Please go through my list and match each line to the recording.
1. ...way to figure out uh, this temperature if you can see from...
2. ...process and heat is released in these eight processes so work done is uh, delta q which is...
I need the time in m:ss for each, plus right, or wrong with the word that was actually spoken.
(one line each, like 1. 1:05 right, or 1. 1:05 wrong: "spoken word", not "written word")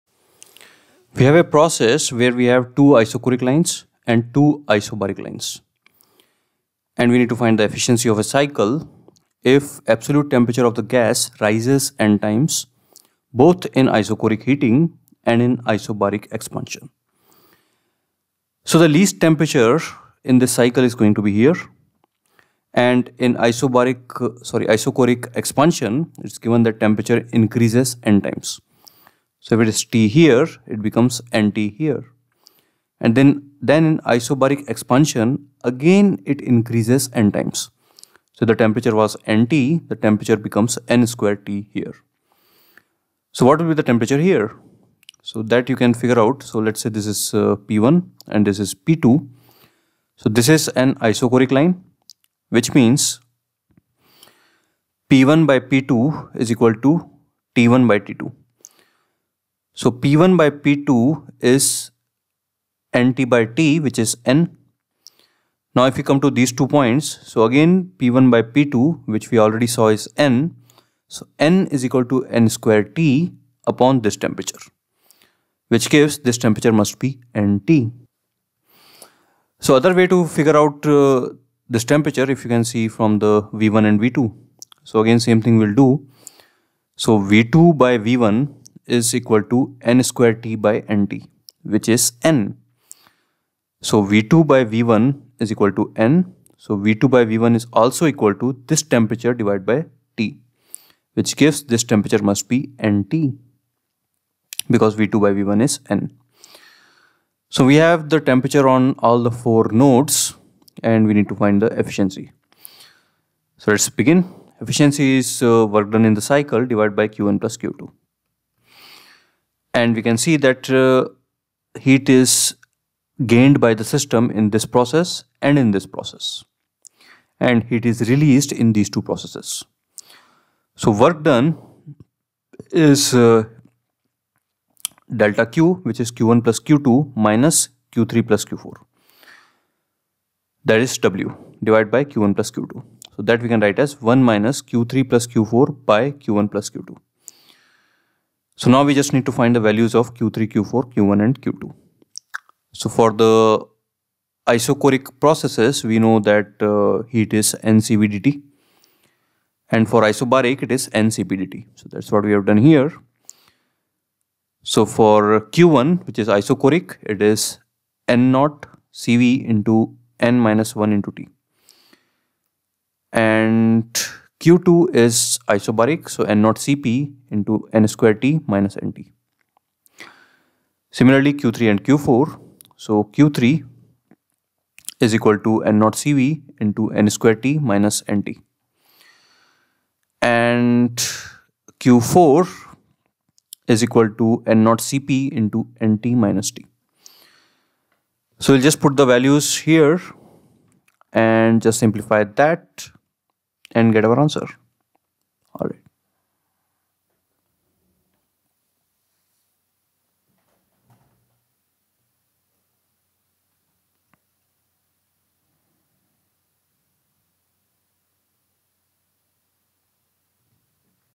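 1. 1:19 right
2. 2:05 wrong: "two", not "eight".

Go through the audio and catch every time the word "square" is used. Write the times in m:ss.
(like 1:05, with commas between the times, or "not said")
0:41, 1:12, 1:30, 2:57, 3:07.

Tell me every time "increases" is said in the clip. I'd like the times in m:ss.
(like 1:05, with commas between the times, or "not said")
0:27, 0:36.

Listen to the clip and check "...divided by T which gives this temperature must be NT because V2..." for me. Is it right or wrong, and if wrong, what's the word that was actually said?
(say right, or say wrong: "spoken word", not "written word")
right.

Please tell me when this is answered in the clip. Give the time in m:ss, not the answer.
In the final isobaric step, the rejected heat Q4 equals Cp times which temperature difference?
3:15.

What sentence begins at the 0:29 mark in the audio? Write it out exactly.
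So if it is T here, it becomes NT here.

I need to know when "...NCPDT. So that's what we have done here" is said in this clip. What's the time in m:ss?
2:40.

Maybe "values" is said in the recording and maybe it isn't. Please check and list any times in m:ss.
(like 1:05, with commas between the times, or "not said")
2:29, 3:19.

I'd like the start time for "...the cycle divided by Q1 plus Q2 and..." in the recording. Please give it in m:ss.
1:56.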